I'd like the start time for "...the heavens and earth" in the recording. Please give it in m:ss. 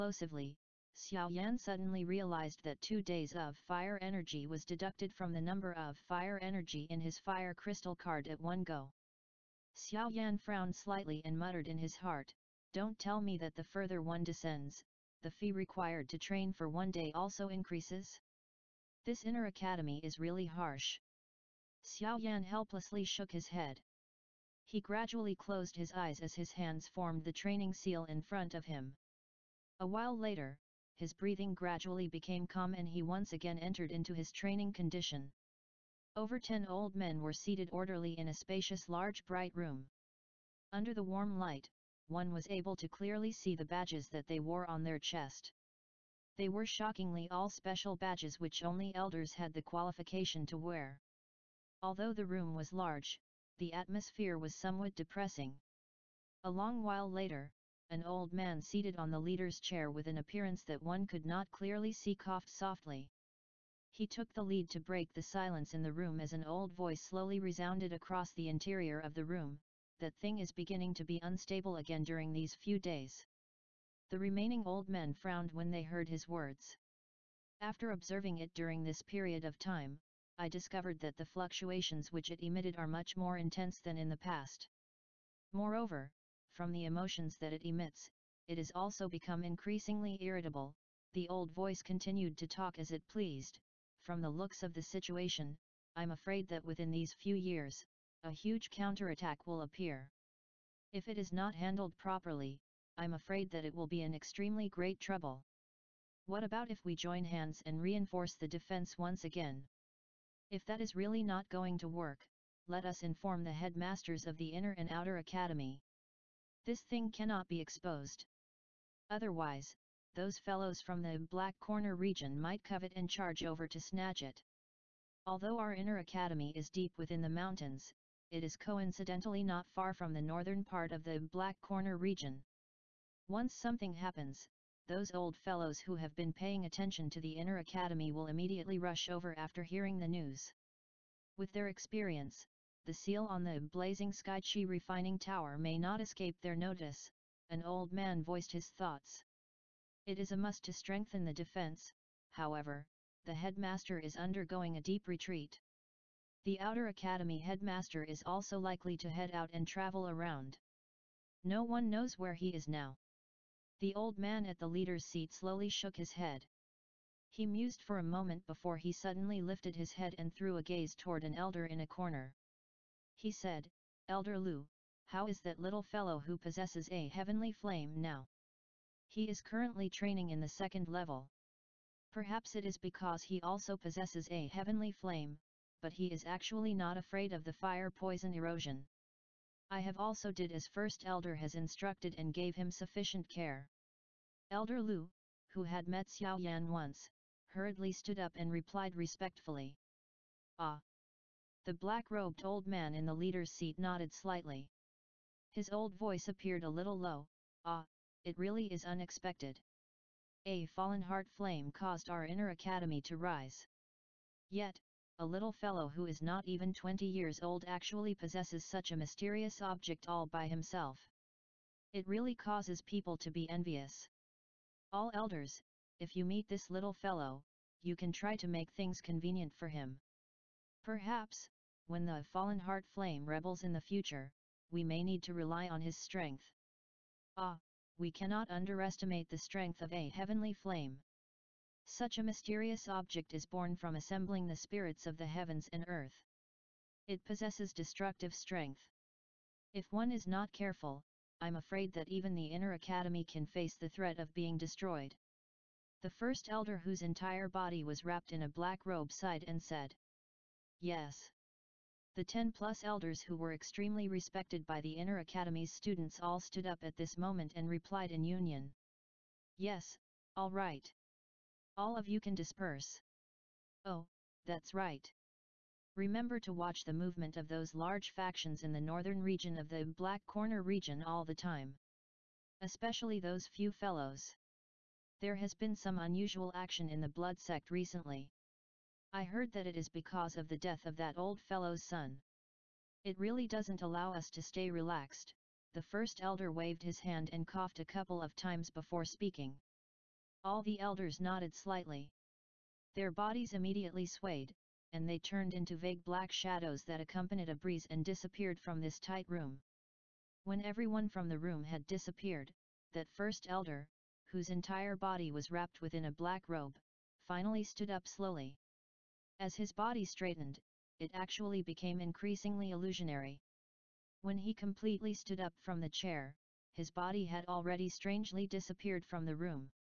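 4:05.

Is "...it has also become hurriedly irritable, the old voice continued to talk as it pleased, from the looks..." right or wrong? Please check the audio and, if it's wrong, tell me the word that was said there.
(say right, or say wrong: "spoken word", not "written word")
wrong: "increasingly", not "hurriedly".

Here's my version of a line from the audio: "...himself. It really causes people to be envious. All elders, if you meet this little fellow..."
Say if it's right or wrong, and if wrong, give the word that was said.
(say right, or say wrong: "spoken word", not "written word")
right.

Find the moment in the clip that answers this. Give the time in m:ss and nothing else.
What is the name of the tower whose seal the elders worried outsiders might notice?
2:23.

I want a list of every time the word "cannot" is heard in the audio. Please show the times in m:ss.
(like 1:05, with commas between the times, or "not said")
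1:57, 3:58.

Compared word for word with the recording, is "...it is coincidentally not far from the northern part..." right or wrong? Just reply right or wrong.
right.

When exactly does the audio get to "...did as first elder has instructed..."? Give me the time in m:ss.
3:10.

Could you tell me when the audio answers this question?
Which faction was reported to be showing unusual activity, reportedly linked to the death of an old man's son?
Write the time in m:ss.
4:47.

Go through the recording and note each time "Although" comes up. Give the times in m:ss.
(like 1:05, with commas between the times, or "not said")
0:51, 2:05.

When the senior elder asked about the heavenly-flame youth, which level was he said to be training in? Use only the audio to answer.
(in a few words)
Second level.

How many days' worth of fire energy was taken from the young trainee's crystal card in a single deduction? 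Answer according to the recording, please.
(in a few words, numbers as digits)
2.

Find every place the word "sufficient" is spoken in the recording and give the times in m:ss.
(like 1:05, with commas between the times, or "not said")
3:12.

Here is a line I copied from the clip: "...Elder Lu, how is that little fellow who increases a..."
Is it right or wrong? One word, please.
wrong.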